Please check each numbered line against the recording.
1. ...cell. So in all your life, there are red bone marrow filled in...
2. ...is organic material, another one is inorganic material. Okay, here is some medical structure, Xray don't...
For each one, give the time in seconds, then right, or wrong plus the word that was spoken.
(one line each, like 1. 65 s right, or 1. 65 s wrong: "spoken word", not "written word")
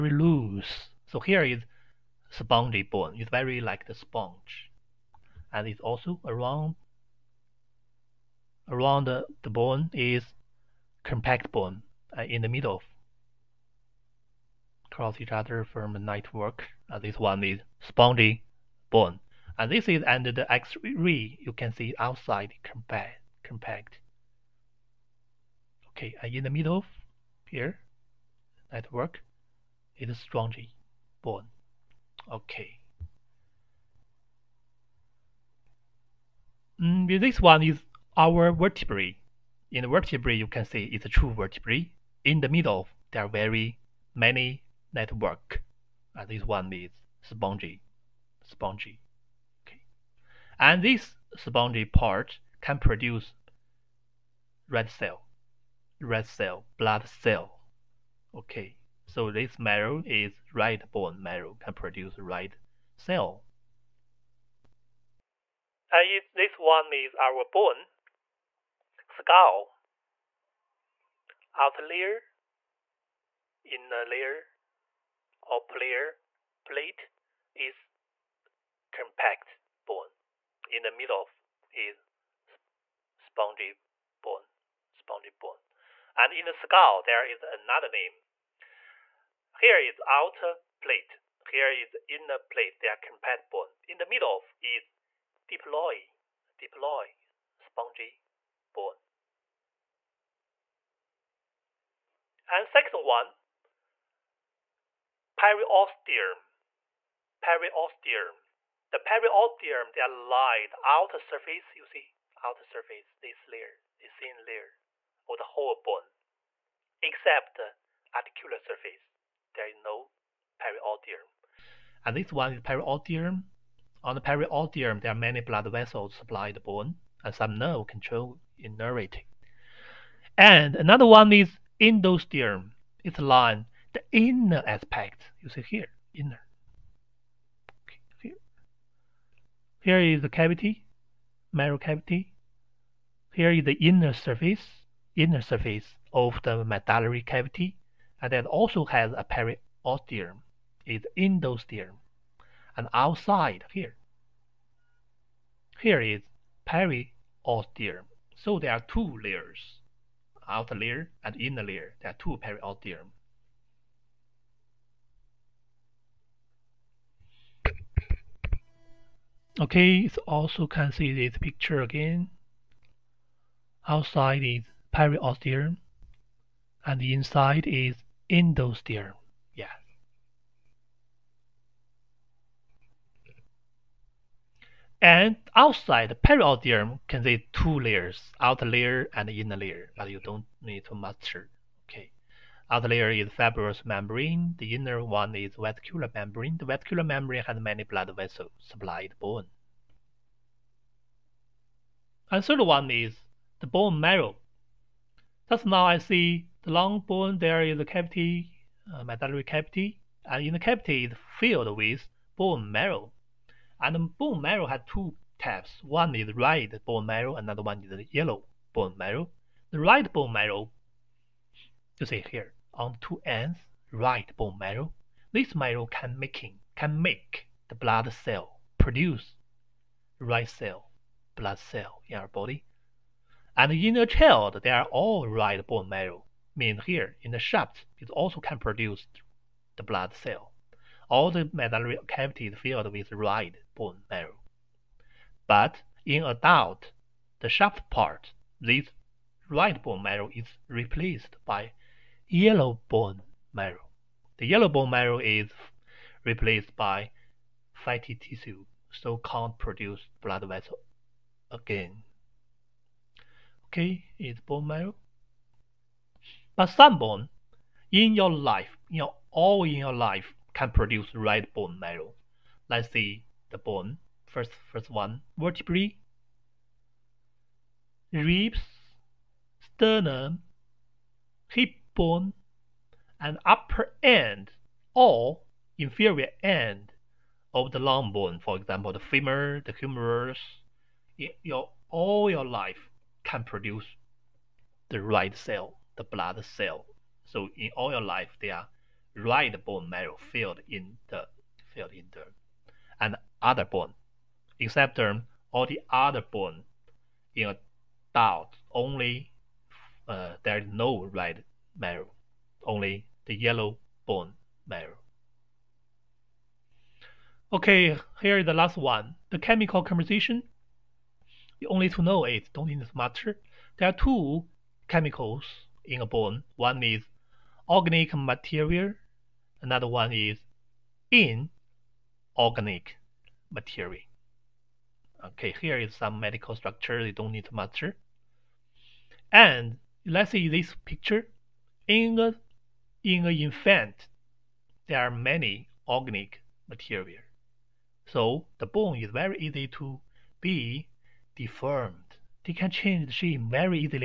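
1. 296 s right
2. 326 s wrong: "You", not "Xray".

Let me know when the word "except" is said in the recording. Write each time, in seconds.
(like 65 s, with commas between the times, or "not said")
117 s, 304 s.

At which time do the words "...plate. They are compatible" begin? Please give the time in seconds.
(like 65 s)
92 s.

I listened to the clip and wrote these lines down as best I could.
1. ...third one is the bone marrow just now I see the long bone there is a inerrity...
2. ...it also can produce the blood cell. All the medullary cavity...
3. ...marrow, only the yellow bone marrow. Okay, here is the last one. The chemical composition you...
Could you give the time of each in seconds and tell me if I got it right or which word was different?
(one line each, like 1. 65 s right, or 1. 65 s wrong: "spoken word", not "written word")
1. 202 s wrong: "cavity", not "inerrity"
2. 237 s right
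3. 311 s right.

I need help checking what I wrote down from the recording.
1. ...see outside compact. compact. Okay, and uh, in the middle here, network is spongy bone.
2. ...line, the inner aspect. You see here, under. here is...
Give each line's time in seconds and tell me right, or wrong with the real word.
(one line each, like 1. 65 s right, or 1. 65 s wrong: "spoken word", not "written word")
1. 21 s right
2. 133 s wrong: "inner", not "under".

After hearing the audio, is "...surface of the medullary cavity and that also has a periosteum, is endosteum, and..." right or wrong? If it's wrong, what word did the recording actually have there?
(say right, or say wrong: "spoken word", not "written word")
right.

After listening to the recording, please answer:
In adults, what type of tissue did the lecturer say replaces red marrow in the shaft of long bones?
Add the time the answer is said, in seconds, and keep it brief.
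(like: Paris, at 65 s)
fatty tissue, at 257 s.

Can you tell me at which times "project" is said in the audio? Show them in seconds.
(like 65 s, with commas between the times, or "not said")
not said.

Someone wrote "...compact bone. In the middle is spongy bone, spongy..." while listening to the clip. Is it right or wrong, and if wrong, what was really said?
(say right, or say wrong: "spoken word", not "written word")
right.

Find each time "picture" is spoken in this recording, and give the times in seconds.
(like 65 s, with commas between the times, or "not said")
171 s, 340 s.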